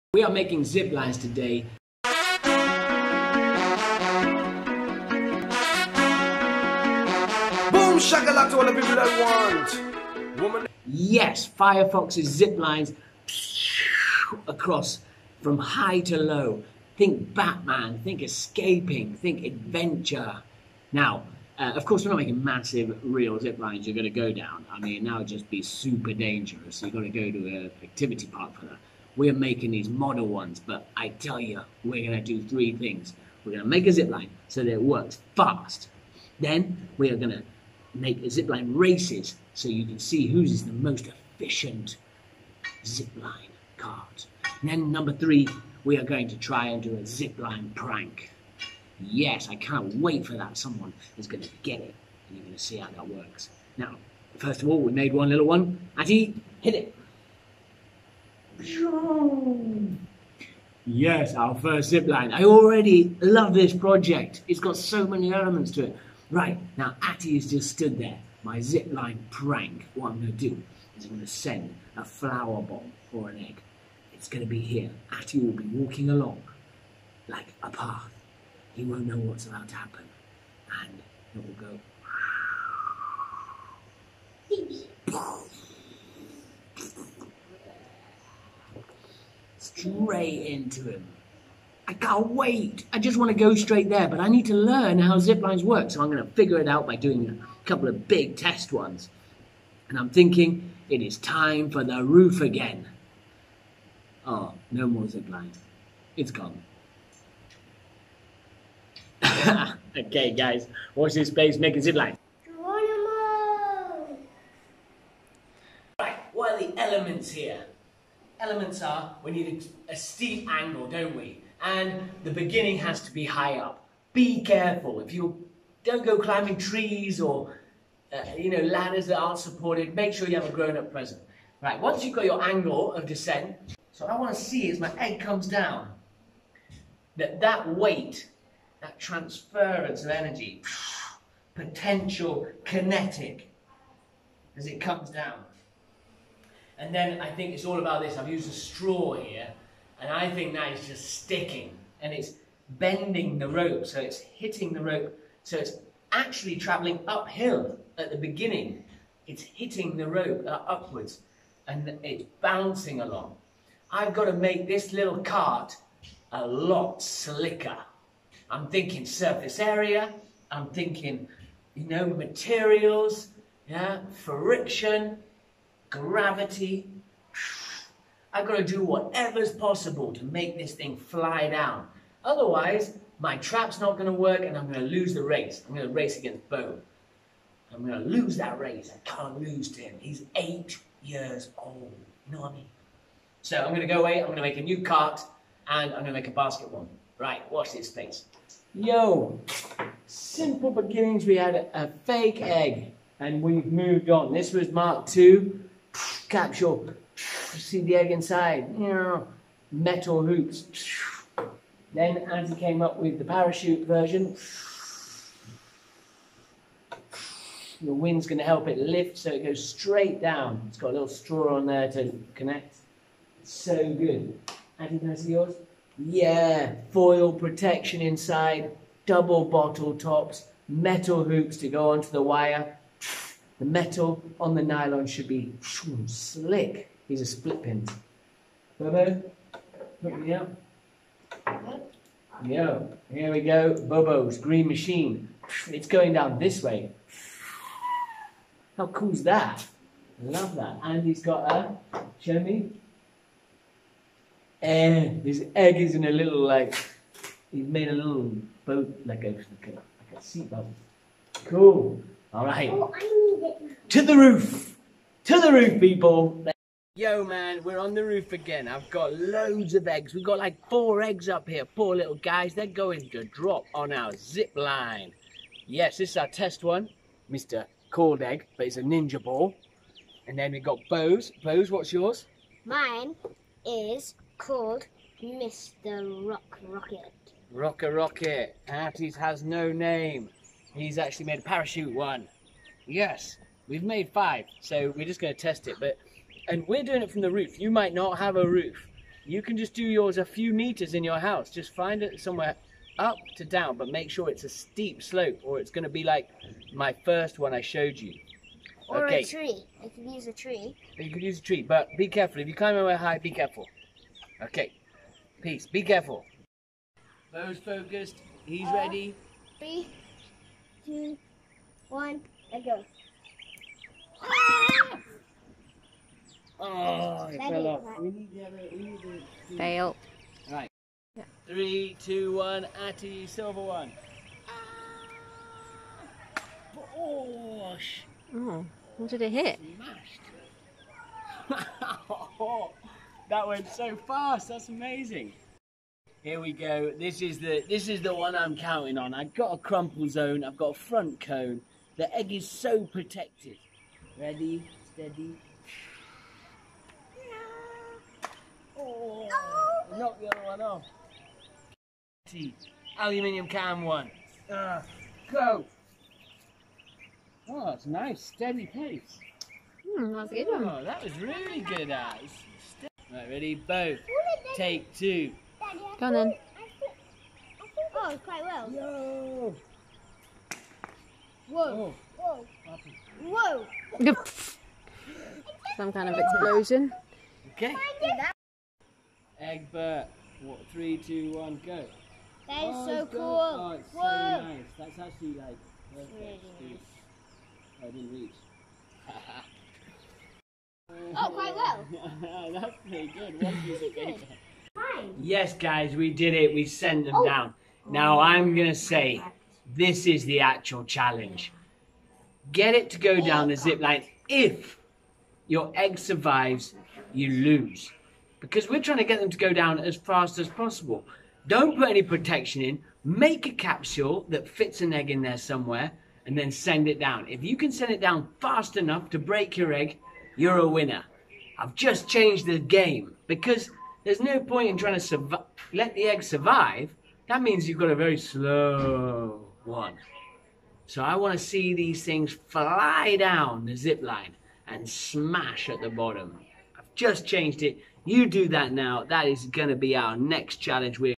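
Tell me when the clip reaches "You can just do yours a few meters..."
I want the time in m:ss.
4:59.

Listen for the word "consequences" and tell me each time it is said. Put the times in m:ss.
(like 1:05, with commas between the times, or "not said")
not said.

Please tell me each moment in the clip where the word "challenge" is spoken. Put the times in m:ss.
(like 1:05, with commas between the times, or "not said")
6:50, 7:30.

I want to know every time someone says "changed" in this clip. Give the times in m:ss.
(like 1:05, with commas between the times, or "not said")
7:12, 7:27.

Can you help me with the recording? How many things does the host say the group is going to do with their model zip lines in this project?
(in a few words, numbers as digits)
3.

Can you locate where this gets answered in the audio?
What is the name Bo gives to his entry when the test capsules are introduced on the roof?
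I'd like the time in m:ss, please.
4:45.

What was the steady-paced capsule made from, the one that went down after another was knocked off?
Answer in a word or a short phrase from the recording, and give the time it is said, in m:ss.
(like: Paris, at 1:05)
Aluminium can, at 6:02.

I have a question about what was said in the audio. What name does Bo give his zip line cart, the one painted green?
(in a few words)
Bobo's green machine.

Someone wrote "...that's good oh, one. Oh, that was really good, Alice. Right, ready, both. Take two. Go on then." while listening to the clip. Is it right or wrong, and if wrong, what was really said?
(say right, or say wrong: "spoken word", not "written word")
right.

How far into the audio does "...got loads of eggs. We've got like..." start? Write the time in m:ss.
4:28.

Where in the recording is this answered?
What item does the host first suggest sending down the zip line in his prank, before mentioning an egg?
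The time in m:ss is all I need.
1:12.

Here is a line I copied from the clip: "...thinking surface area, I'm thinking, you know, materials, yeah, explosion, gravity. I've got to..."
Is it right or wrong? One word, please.
wrong.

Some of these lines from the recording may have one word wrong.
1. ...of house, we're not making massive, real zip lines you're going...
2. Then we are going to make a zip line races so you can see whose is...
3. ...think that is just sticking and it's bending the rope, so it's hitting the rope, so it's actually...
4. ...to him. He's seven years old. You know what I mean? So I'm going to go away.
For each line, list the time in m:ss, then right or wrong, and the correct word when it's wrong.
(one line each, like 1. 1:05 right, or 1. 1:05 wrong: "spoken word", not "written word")
1. 0:21 wrong: "course", not "house"
2. 0:36 right
3. 2:30 right
4. 3:09 wrong: "eight", not "seven".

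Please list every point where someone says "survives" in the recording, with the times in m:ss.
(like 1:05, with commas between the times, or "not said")
6:55, 7:16.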